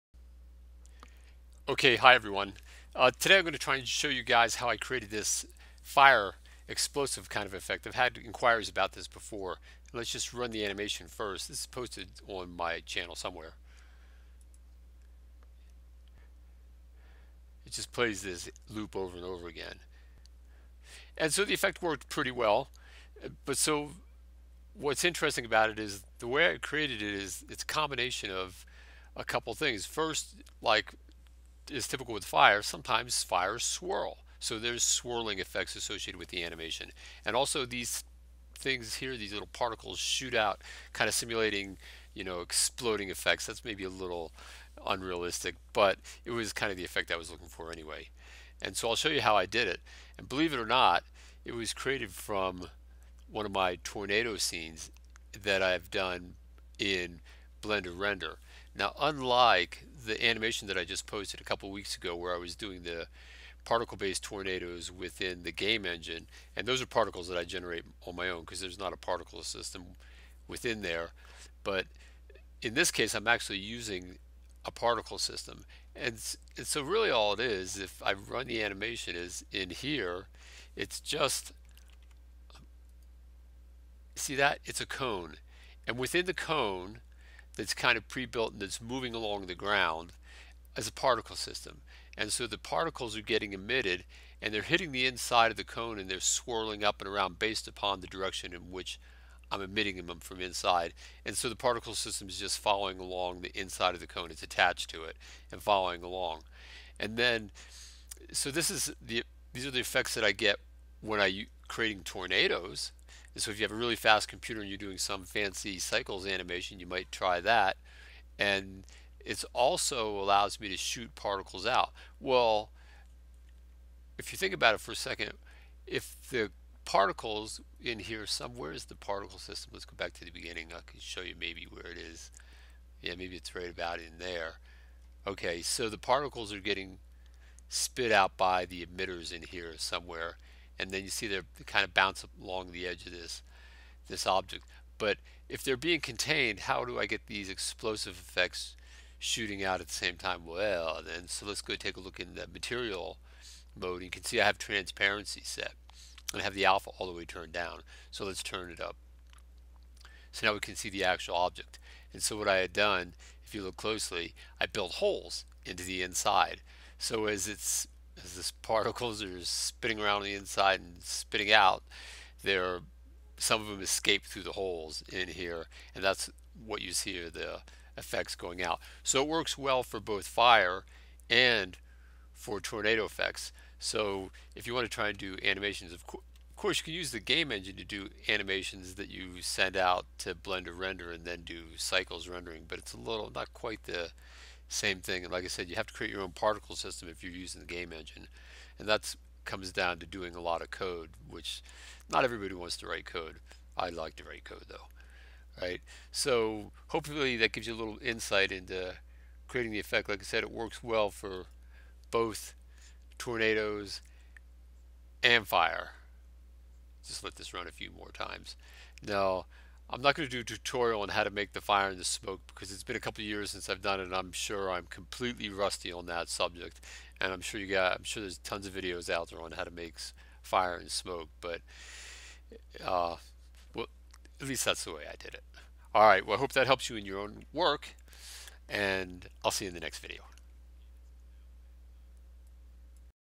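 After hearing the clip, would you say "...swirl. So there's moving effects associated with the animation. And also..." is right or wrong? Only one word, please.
wrong.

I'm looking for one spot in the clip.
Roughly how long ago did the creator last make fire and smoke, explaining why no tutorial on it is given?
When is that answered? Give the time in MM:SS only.
03:42.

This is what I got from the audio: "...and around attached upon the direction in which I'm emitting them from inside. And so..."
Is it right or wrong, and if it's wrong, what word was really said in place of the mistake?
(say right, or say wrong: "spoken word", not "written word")
wrong: "based", not "attached".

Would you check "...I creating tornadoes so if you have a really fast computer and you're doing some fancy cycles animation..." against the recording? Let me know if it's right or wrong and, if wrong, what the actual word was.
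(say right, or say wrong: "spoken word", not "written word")
right.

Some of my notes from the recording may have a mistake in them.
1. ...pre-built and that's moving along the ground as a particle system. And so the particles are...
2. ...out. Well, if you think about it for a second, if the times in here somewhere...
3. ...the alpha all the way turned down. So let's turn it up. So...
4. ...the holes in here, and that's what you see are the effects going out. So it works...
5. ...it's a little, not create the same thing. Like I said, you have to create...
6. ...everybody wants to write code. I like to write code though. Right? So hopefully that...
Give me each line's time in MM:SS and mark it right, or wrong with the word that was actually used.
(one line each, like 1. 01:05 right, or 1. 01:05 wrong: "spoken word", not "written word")
1. 01:28 right
2. 02:01 wrong: "particles", not "times"
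3. 02:36 right
4. 02:54 right
5. 03:12 wrong: "quite", not "create"
6. 03:22 right.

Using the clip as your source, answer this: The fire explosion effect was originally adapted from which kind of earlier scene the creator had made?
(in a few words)
Tornado scenes.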